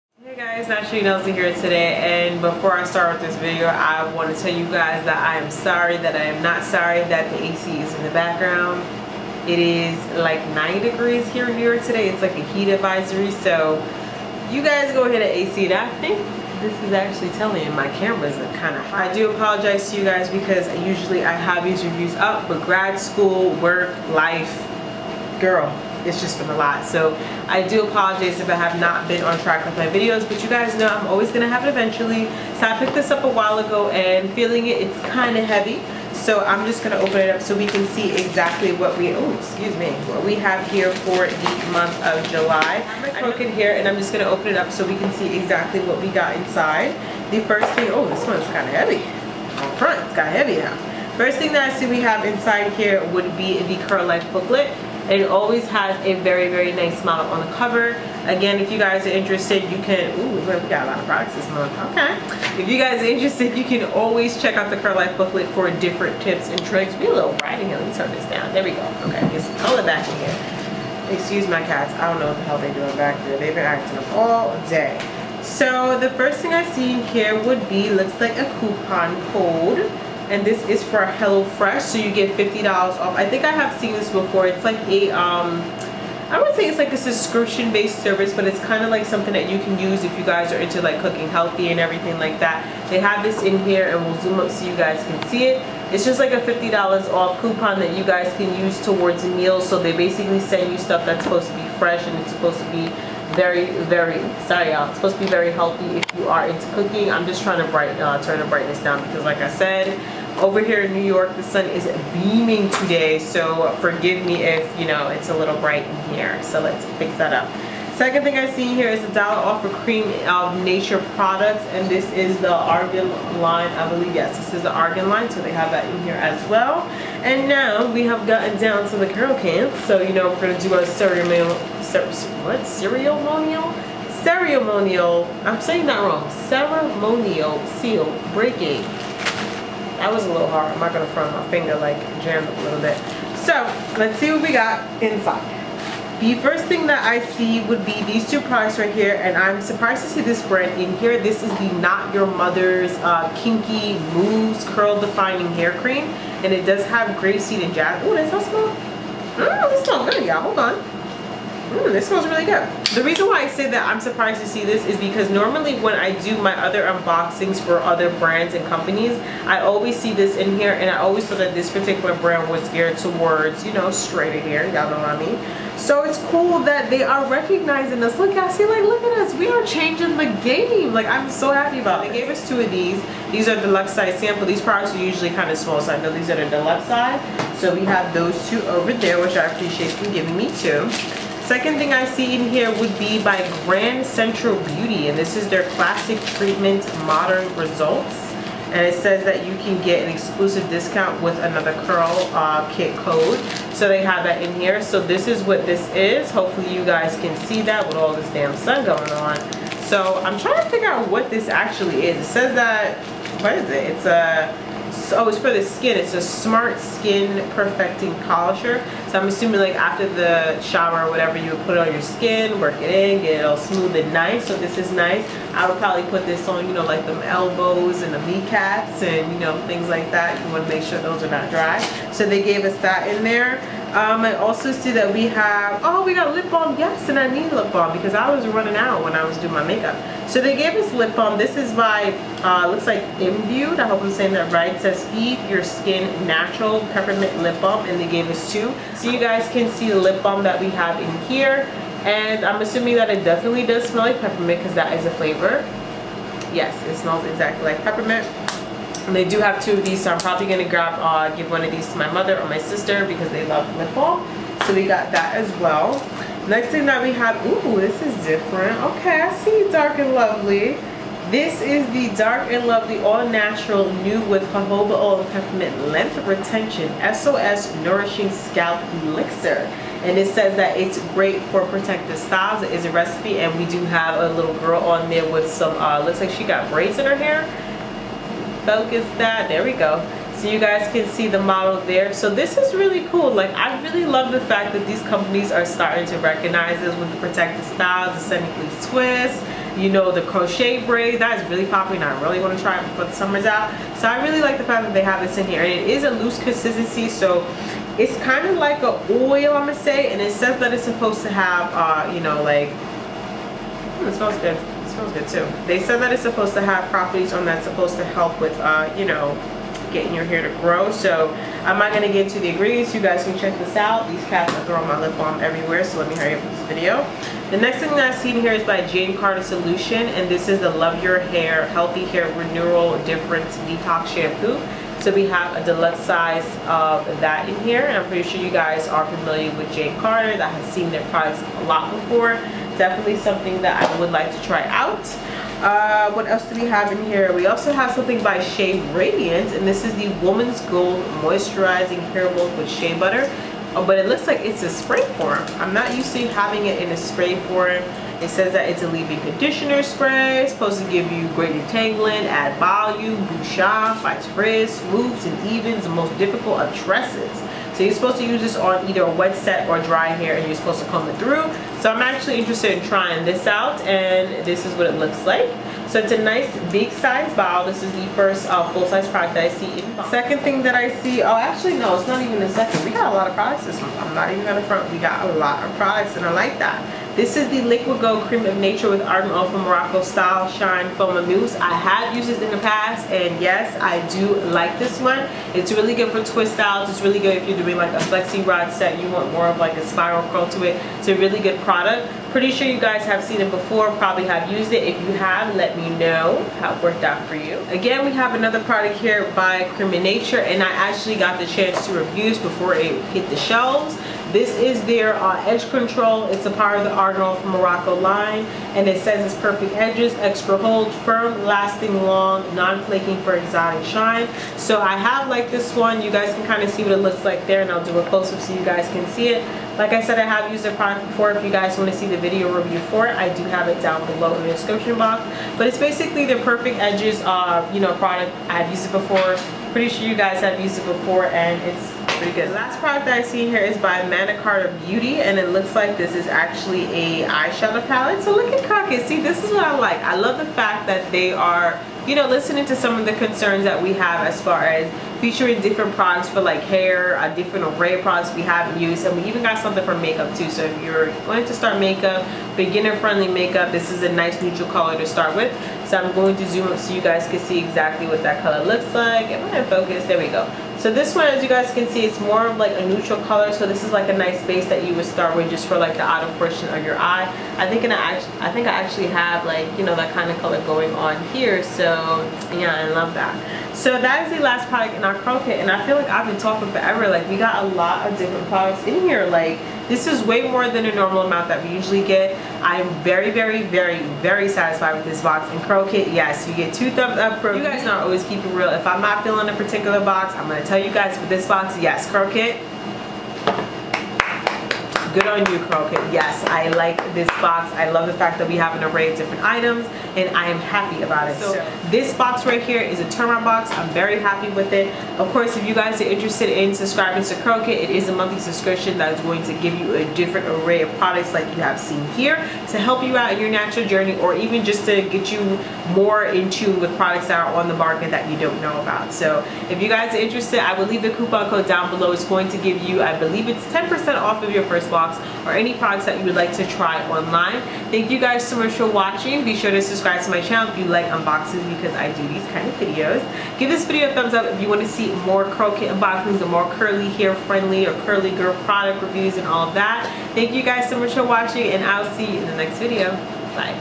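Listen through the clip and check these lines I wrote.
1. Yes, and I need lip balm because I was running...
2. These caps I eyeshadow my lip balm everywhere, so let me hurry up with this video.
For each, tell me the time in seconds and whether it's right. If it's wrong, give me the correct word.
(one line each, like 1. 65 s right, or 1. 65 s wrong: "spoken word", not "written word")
1. 236 s right
2. 324 s wrong: "throw", not "eyeshadow".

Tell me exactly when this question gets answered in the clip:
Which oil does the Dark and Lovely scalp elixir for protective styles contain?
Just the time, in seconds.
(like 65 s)
274 s.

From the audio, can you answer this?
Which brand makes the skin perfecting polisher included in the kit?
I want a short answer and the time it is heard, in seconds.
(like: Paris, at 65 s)
Grand Central Beauty, at 193 s.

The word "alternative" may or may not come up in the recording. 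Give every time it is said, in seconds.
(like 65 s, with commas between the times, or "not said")
not said.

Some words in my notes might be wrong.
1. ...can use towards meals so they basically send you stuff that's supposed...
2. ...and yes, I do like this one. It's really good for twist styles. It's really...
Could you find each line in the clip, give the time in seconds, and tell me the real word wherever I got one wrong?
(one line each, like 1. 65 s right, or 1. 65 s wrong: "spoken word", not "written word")
1. 98 s right
2. 393 s right.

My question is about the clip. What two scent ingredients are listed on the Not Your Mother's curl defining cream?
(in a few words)
grapeseed and jasmine.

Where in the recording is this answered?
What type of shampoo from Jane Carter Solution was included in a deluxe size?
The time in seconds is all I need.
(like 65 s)
333 s.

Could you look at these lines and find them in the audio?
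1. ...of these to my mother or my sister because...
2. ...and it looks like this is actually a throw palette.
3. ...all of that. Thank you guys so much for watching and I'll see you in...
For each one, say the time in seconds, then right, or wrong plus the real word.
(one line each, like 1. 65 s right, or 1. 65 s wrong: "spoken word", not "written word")
1. 261 s right
2. 445 s wrong: "eyeshadow", not "throw"
3. 549 s right.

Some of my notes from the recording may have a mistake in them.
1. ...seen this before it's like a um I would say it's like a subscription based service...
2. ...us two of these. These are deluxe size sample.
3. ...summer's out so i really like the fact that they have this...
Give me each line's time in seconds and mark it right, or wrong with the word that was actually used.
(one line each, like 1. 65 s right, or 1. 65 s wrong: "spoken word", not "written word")
1. 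83 s right
2. 182 s right
3. 303 s right.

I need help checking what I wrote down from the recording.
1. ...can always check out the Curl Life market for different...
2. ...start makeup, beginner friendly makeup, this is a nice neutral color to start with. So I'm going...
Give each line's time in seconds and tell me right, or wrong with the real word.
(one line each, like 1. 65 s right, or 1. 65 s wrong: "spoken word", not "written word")
1. 63 s wrong: "booklet", not "market"
2. 461 s right.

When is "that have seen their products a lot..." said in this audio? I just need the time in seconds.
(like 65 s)
340 s.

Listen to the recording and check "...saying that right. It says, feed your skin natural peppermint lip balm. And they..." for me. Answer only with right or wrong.
right.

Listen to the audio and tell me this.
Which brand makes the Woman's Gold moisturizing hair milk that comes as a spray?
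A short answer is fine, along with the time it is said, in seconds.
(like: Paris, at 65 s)
Shea Radiance, at 348 s.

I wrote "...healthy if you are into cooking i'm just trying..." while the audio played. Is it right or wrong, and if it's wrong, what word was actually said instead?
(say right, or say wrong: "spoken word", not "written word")
right.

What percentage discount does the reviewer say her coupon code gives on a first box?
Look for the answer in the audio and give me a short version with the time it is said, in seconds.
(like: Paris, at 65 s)
10%, at 533 s.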